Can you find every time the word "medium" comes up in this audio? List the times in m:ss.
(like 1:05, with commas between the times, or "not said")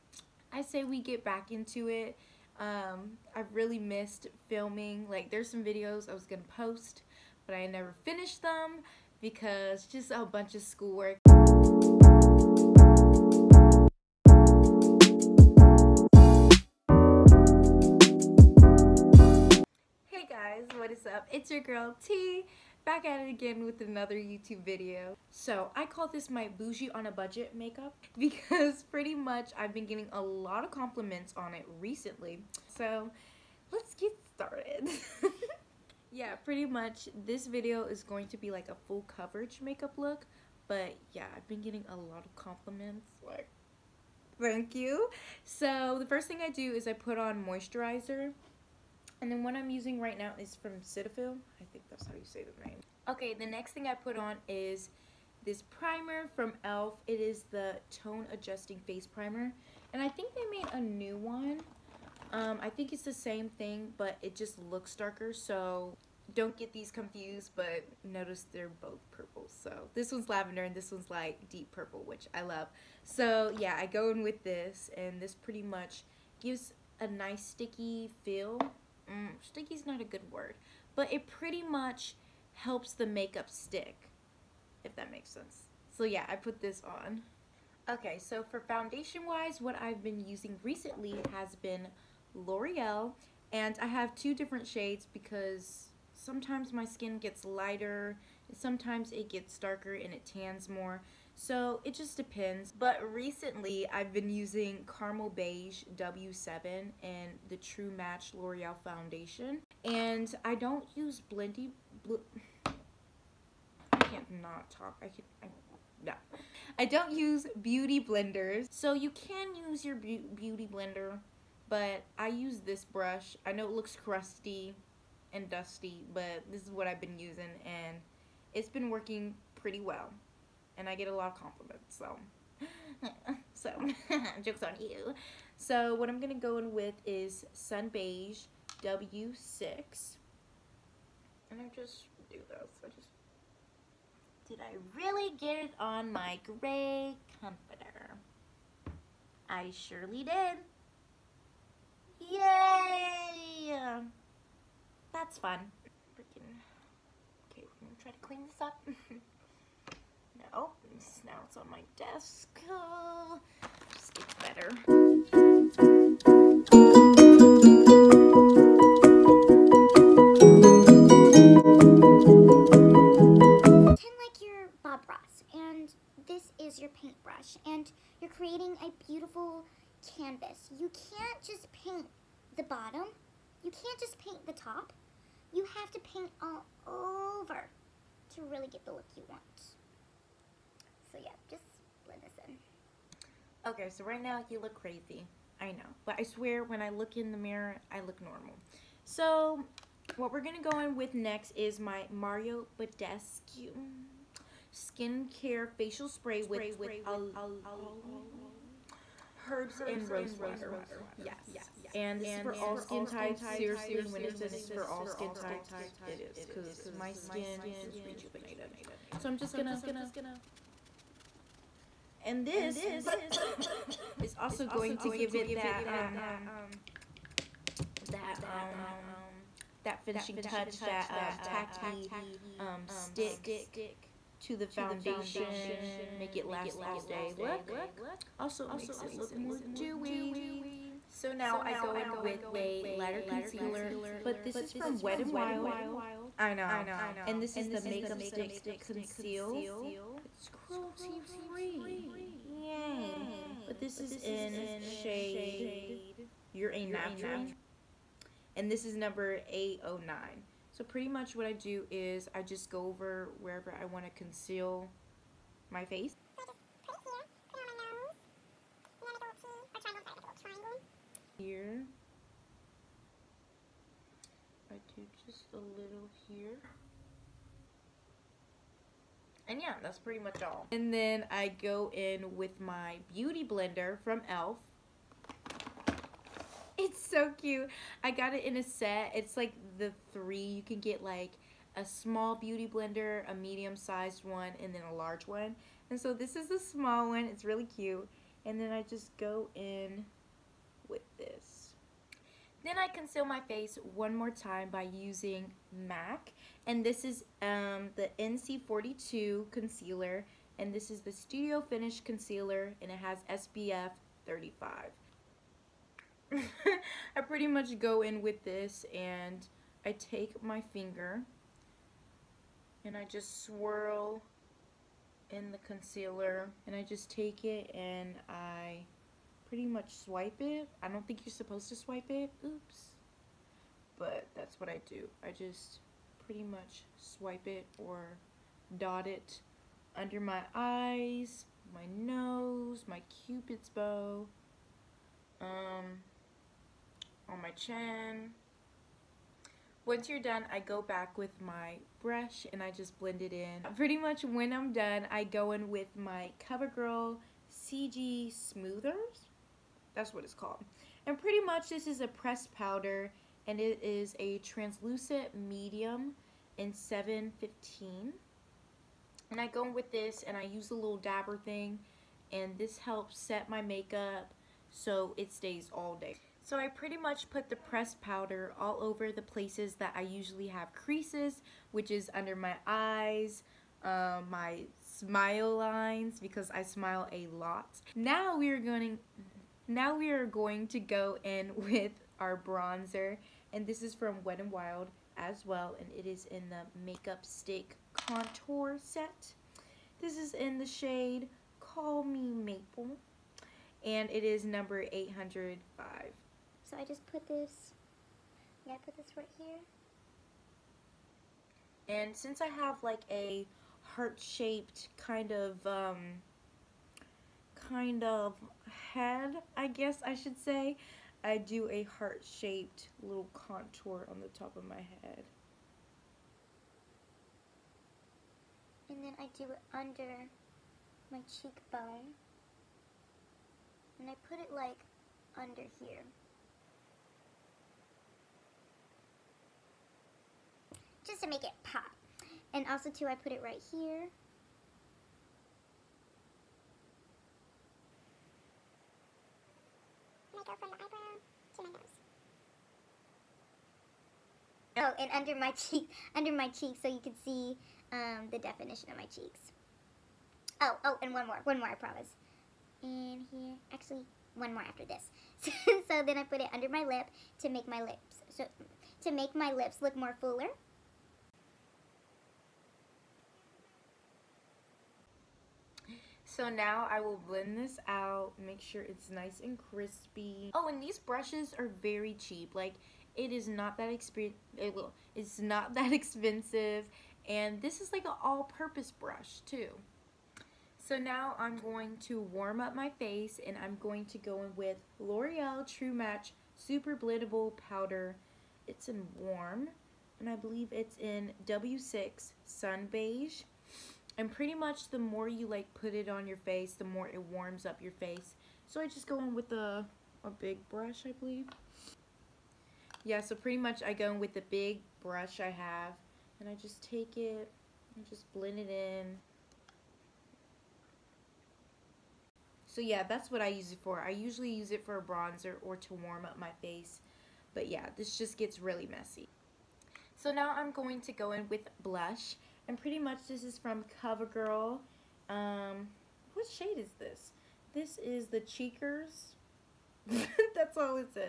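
4:53, 6:05.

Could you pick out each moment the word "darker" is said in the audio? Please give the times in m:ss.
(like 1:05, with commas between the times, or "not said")
1:04, 1:39.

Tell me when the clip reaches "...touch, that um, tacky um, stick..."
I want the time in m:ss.
3:50.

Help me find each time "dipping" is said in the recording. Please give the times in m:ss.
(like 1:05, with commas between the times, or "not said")
not said.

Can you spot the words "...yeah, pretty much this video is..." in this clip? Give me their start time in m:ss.
0:36.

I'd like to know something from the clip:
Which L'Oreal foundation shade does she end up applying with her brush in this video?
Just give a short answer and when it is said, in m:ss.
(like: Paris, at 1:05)
Sun Beige W6, at 2:17.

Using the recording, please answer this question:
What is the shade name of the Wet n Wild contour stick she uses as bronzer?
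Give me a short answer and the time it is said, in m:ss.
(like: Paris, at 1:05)
Call Me Maple, at 6:41.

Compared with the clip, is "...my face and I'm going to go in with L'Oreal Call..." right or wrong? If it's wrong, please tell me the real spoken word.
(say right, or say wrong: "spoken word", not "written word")
wrong: "True", not "Call".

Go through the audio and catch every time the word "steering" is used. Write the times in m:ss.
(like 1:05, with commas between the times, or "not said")
not said.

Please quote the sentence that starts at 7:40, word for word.
Oh, oh, and one more, one more, I promise.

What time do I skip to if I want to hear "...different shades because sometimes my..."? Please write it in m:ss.
1:34.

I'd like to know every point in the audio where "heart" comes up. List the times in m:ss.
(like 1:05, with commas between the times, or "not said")
6:53, 7:01.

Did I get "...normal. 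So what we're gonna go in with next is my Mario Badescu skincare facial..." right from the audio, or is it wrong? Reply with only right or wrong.
right.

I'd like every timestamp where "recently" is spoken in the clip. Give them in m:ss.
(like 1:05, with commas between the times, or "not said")
0:31, 1:30, 1:43.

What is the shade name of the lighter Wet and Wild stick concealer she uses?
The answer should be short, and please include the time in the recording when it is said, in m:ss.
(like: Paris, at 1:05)
You're a Natural, at 4:16.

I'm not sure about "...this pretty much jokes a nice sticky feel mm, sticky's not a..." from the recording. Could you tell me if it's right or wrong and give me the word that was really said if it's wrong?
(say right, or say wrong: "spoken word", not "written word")
wrong: "gives", not "jokes".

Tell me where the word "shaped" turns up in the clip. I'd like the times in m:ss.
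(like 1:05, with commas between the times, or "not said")
6:53, 7:01.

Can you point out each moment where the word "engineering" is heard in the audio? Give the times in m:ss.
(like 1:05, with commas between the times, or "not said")
not said.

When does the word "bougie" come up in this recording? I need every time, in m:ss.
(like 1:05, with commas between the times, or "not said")
0:26.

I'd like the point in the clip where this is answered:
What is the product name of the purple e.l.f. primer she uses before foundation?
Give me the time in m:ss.
0:57.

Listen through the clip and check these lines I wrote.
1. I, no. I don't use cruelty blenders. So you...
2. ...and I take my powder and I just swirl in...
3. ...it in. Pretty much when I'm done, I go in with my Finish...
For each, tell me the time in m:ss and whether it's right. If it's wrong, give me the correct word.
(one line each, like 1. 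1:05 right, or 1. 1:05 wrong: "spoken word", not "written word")
1. 1:55 wrong: "beauty", not "cruelty"
2. 5:18 wrong: "finger", not "powder"
3. 5:53 wrong: "CoverGirl", not "Finish".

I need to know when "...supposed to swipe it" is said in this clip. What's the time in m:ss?
5:31.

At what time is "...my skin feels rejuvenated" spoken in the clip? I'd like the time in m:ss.
3:36.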